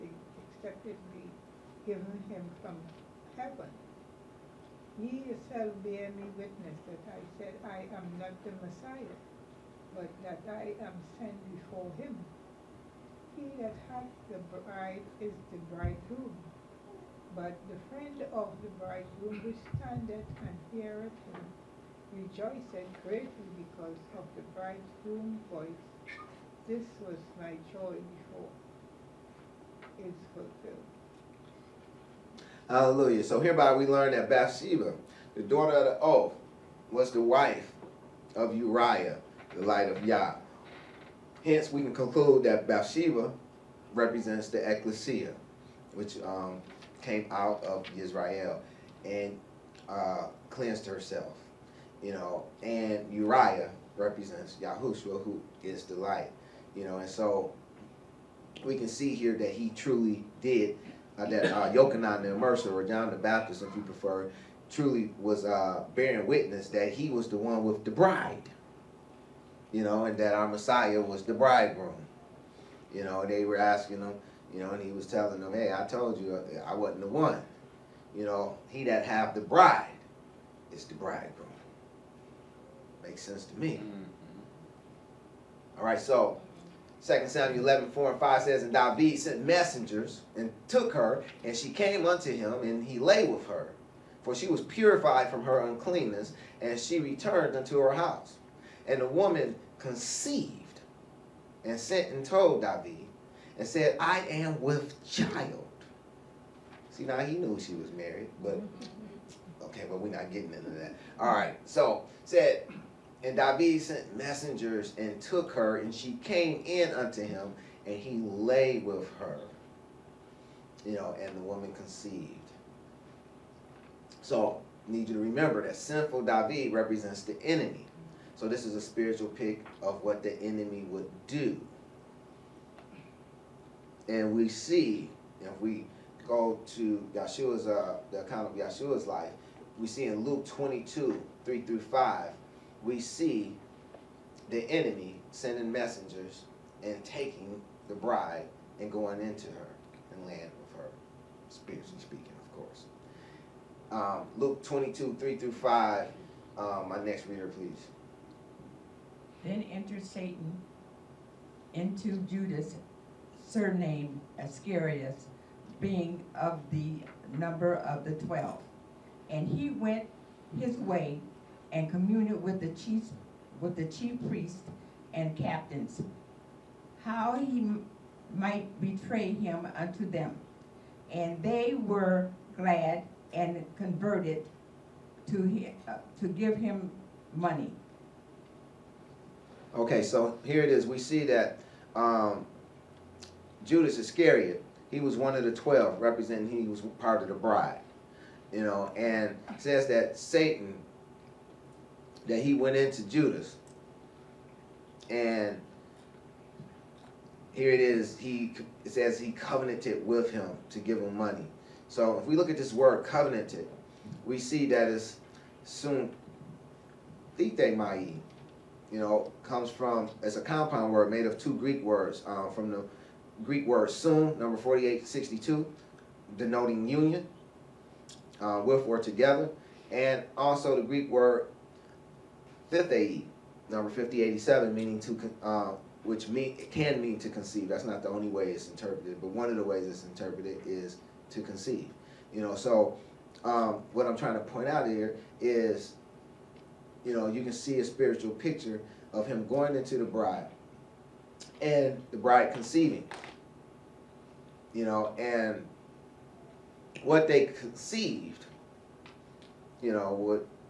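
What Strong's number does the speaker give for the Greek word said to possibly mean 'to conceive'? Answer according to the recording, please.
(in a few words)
5087.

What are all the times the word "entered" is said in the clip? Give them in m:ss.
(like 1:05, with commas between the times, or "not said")
2:39.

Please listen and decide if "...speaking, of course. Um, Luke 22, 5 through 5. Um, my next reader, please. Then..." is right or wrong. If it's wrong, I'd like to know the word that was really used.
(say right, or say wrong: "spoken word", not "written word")
wrong: "3", not "5".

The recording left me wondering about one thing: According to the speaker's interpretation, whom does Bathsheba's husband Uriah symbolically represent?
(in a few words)
Yahushua.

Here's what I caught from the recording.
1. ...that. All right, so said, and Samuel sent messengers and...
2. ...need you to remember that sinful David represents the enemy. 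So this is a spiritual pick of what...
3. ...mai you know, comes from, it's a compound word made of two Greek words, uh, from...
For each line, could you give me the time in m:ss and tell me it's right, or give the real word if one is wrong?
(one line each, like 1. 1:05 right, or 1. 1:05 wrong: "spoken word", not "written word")
1. 1:50 wrong: "David", not "Samuel"
2. 2:04 right
3. 3:37 right.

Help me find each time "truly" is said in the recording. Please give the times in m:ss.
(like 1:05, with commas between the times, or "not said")
0:59, 1:04.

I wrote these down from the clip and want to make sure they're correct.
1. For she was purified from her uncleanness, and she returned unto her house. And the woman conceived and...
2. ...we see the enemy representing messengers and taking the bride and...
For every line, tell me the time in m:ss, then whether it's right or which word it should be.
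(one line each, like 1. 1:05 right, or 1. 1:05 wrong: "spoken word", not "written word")
1. 1:34 right
2. 2:22 wrong: "sending", not "representing".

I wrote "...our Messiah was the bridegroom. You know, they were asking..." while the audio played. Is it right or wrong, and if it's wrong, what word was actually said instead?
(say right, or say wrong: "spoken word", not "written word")
right.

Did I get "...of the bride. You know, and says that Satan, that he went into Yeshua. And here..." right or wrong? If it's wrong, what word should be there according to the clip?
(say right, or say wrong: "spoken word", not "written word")
wrong: "Judas", not "Yeshua".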